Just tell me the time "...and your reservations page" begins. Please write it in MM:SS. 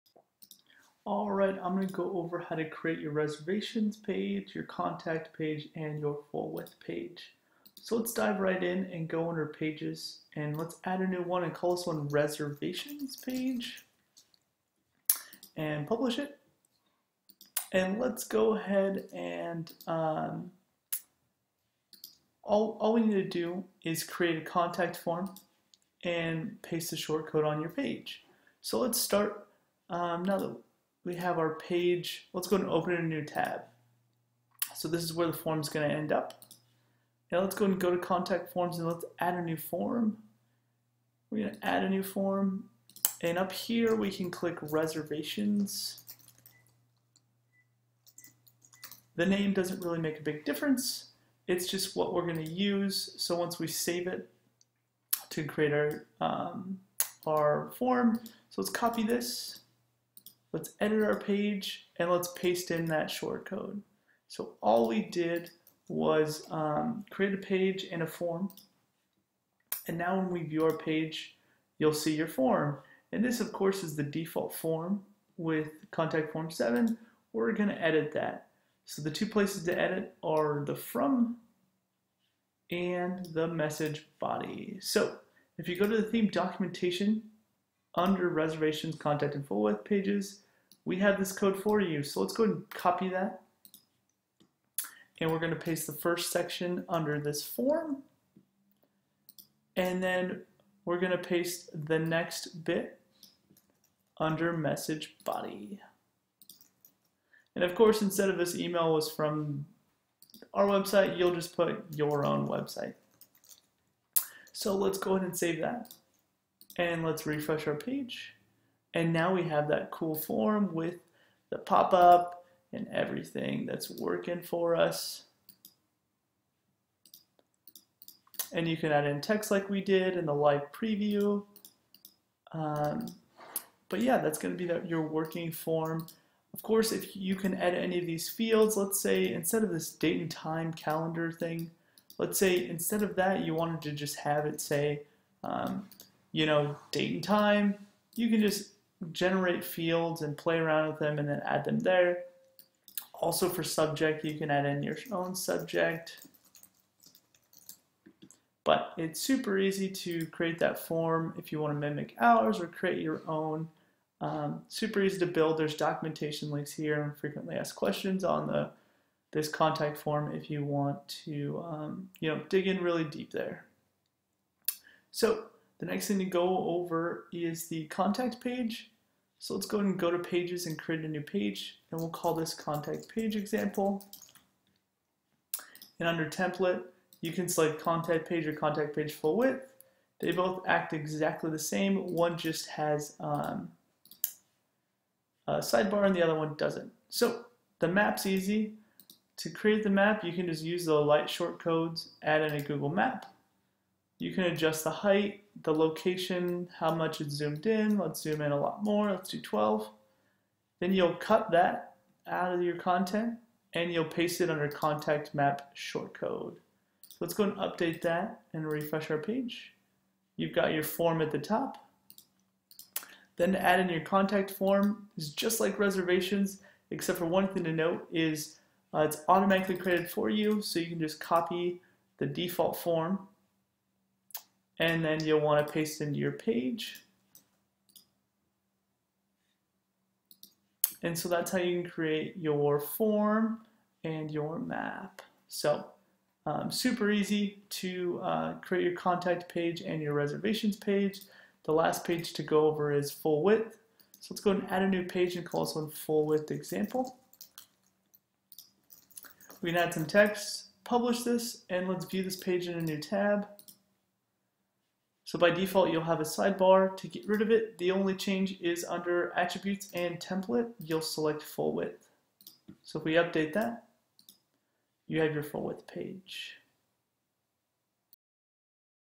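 04:09.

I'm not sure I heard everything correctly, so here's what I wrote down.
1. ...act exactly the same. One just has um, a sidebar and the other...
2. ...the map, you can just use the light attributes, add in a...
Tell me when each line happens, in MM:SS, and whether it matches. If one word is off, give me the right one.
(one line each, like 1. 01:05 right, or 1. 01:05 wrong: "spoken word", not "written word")
1. 03:10 right
2. 03:19 wrong: "shortcodes", not "attributes".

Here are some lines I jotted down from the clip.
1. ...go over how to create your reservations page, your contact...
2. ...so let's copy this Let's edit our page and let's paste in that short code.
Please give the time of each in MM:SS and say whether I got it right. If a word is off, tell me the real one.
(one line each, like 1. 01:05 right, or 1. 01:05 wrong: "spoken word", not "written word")
1. 00:01 right
2. 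00:58 right.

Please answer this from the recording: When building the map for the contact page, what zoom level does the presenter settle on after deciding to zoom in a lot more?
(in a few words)
12.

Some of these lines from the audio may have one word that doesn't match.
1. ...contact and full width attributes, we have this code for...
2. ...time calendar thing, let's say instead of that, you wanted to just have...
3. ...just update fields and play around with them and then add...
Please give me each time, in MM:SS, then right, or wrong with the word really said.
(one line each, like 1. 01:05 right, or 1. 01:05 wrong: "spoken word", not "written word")
1. 01:28 wrong: "pages", not "attributes"
2. 02:20 right
3. 02:28 wrong: "generate", not "update".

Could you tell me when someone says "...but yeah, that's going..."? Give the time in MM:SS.
02:13.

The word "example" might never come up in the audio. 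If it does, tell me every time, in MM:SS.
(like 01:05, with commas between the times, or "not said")
03:03, 04:16.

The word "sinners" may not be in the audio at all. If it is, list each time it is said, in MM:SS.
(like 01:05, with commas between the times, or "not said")
not said.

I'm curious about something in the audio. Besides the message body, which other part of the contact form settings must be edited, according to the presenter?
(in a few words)
the from.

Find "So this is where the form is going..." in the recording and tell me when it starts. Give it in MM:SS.
00:34.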